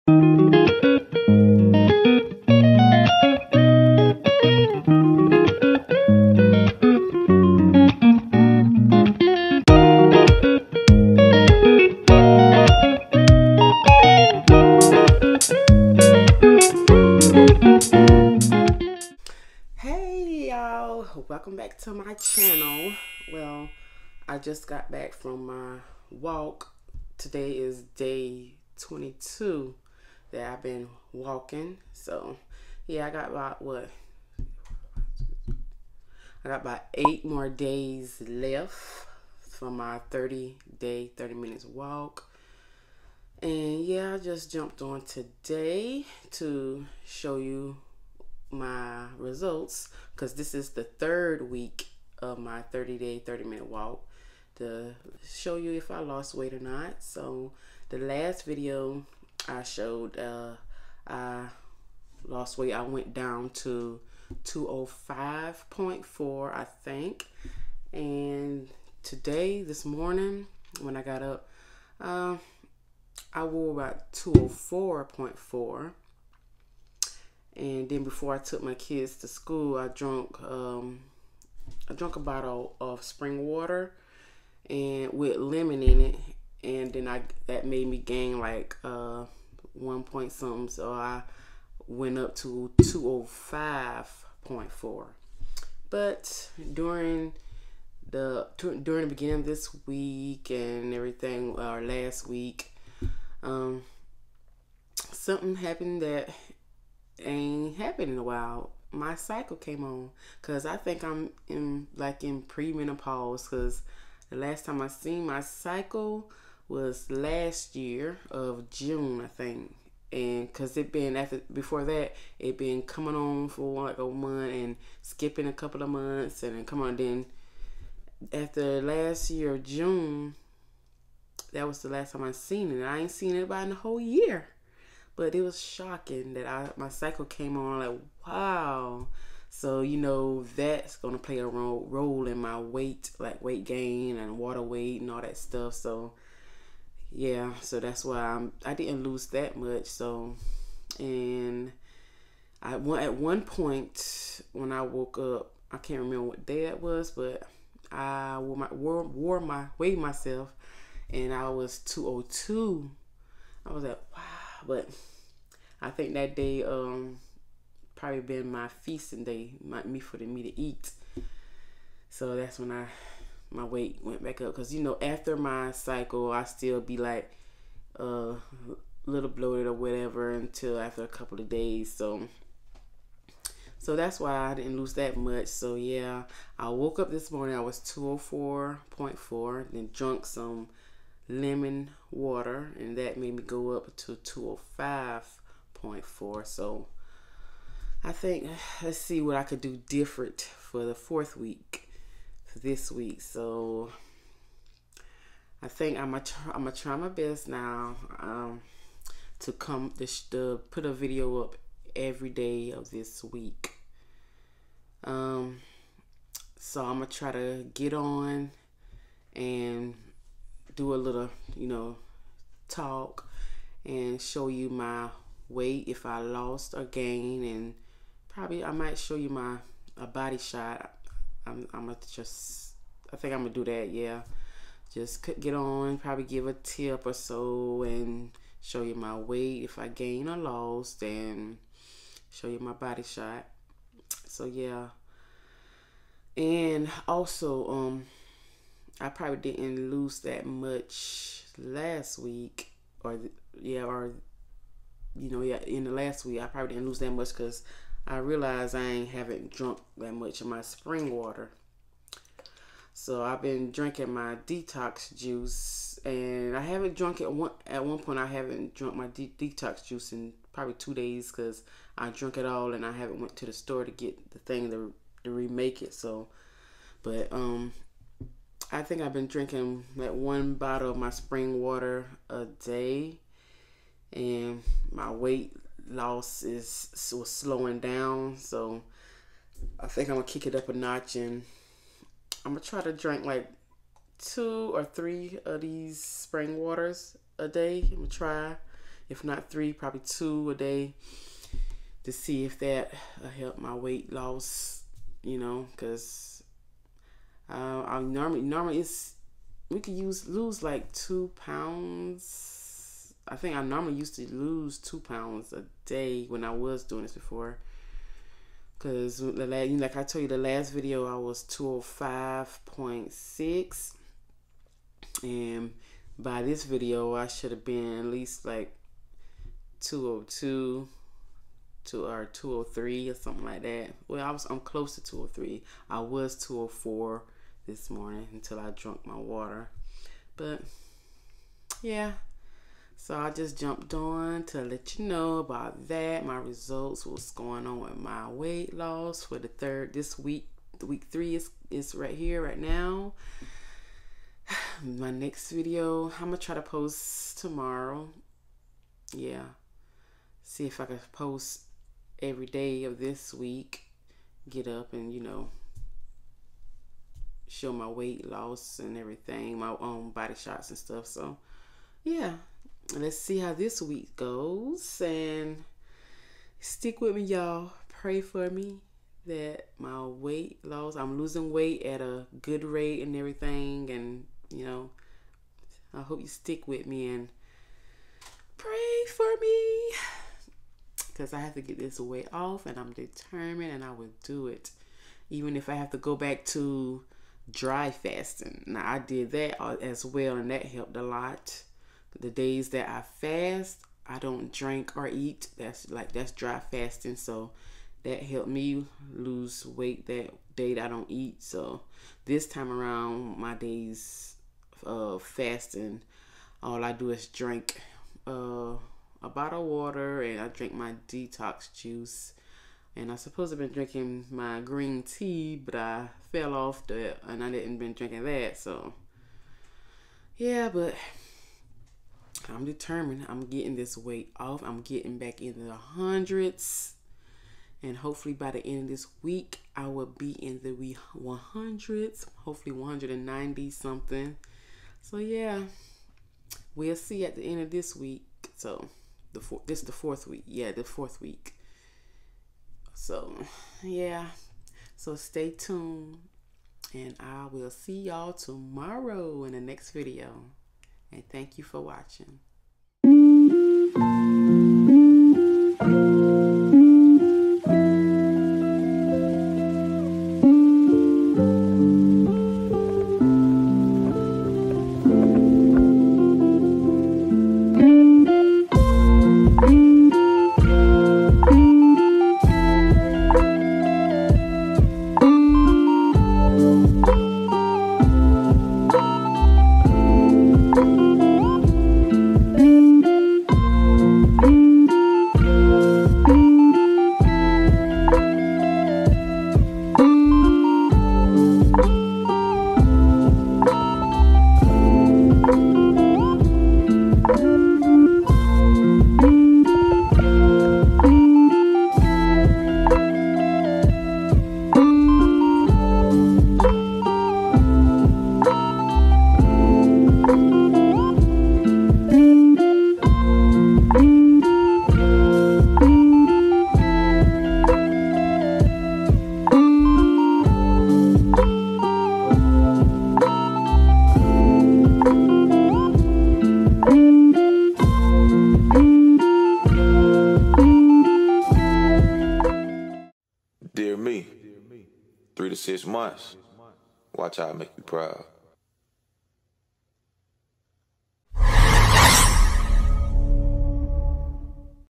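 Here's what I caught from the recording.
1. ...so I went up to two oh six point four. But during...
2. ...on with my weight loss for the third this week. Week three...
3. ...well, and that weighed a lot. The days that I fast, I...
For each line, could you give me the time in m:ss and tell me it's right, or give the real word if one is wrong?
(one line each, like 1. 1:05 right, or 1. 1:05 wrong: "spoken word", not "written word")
1. 1:30 wrong: "five", not "six"
2. 5:47 right
3. 6:40 wrong: "helped", not "weighed".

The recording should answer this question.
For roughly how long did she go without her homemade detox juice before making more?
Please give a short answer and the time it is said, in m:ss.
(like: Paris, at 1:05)
two days, at 4:30.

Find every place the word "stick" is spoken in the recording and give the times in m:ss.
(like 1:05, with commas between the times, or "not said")
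6:16, 6:26.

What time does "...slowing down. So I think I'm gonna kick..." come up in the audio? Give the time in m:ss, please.
4:47.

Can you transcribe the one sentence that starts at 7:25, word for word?
So yeah, we'll see at the end of this week.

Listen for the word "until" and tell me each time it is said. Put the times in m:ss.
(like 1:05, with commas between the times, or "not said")
3:00, 5:38.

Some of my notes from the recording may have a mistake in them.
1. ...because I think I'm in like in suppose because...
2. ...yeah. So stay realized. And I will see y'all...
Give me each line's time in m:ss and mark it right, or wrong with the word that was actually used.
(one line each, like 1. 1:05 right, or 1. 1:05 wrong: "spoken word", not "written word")
1. 1:50 wrong: "premenopause", not "suppose"
2. 7:33 wrong: "tuned", not "realized".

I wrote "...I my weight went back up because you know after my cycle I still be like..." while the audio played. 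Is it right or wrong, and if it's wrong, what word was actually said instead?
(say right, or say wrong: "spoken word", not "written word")
right.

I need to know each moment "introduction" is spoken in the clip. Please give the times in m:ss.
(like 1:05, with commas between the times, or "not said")
not said.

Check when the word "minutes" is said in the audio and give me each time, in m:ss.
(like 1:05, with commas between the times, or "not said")
0:41, 0:53.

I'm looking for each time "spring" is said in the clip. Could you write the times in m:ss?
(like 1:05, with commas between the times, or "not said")
1:23, 4:20, 4:41, 4:56.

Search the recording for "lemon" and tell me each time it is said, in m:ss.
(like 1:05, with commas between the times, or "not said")
1:25, 3:11.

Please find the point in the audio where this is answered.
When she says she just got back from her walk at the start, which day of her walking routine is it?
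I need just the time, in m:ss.
0:28.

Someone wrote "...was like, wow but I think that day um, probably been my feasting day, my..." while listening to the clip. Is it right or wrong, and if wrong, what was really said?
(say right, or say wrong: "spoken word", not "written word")
right.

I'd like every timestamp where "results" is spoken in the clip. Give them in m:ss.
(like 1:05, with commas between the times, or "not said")
0:49, 5:46.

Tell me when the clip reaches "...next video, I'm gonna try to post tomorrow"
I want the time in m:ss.
5:55.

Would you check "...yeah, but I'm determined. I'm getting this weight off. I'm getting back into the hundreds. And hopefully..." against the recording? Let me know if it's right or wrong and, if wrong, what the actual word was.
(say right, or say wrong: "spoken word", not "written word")
right.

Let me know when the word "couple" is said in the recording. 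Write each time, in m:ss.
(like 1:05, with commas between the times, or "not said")
2:05, 3:01.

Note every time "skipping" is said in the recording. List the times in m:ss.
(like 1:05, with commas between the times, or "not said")
2:05.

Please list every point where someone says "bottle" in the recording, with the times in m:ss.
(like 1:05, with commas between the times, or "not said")
1:22, 4:40, 6:59.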